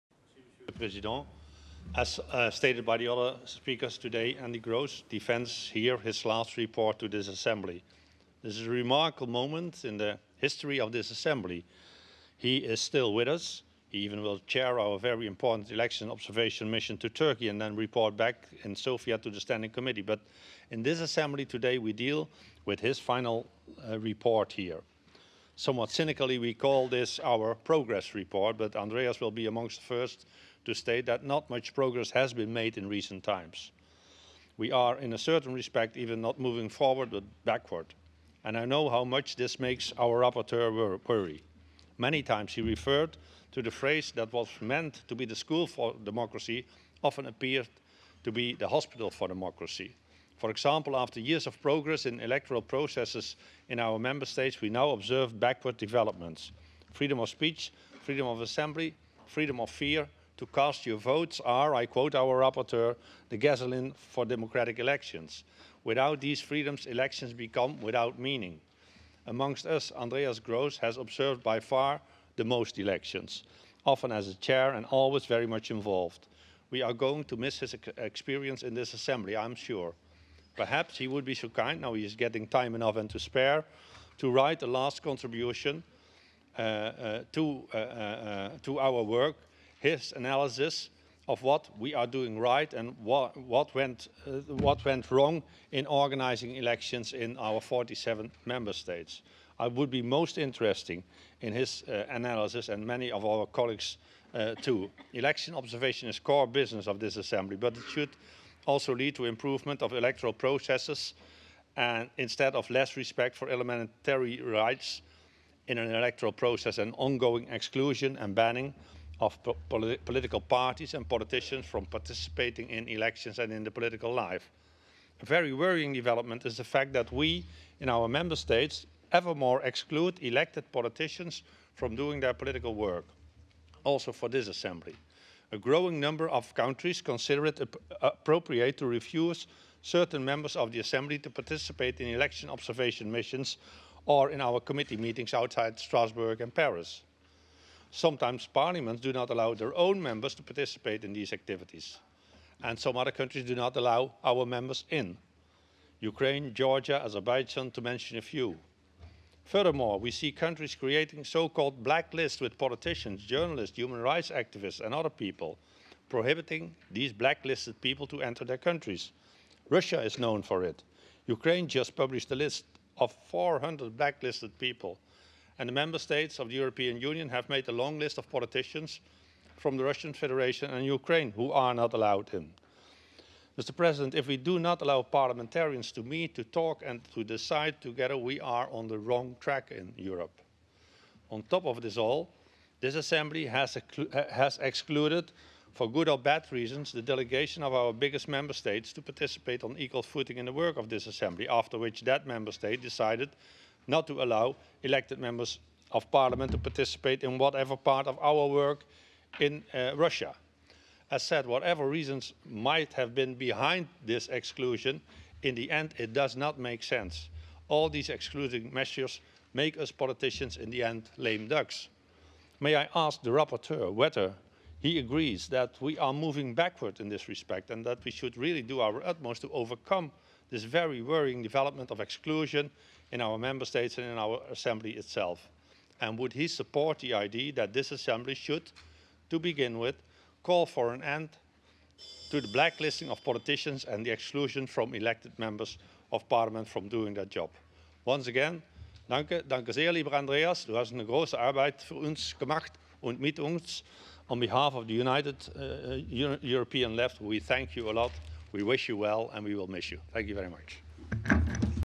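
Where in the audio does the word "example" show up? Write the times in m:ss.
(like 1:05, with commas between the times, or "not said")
0:50.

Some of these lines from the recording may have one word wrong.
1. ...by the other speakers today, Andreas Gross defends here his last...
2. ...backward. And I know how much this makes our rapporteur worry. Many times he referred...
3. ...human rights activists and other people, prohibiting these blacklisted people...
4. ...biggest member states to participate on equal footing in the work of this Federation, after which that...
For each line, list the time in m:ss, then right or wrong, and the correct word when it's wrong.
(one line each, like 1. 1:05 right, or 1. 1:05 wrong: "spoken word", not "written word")
1. 0:02 right
2. 0:37 right
3. 2:43 right
4. 3:17 wrong: "Assembly", not "Federation".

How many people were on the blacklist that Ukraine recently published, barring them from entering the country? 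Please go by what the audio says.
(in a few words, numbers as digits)
400.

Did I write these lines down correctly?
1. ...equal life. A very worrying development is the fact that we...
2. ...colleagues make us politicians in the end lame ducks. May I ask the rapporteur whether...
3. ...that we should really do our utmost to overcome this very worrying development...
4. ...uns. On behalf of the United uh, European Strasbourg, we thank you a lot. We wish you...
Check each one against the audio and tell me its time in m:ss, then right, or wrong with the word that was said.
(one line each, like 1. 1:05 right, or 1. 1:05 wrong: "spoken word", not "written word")
1. 2:03 wrong: "political", not "equal"
2. 3:38 wrong: "measures", not "colleagues"
3. 3:47 right
4. 4:13 wrong: "Left", not "Strasbourg".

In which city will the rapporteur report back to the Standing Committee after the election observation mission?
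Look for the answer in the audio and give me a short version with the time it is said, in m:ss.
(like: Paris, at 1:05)
Sofia, at 0:18.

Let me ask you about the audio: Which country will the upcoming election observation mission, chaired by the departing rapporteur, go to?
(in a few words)
Turkey.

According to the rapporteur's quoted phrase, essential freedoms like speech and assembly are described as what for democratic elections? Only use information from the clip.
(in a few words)
the gasoline.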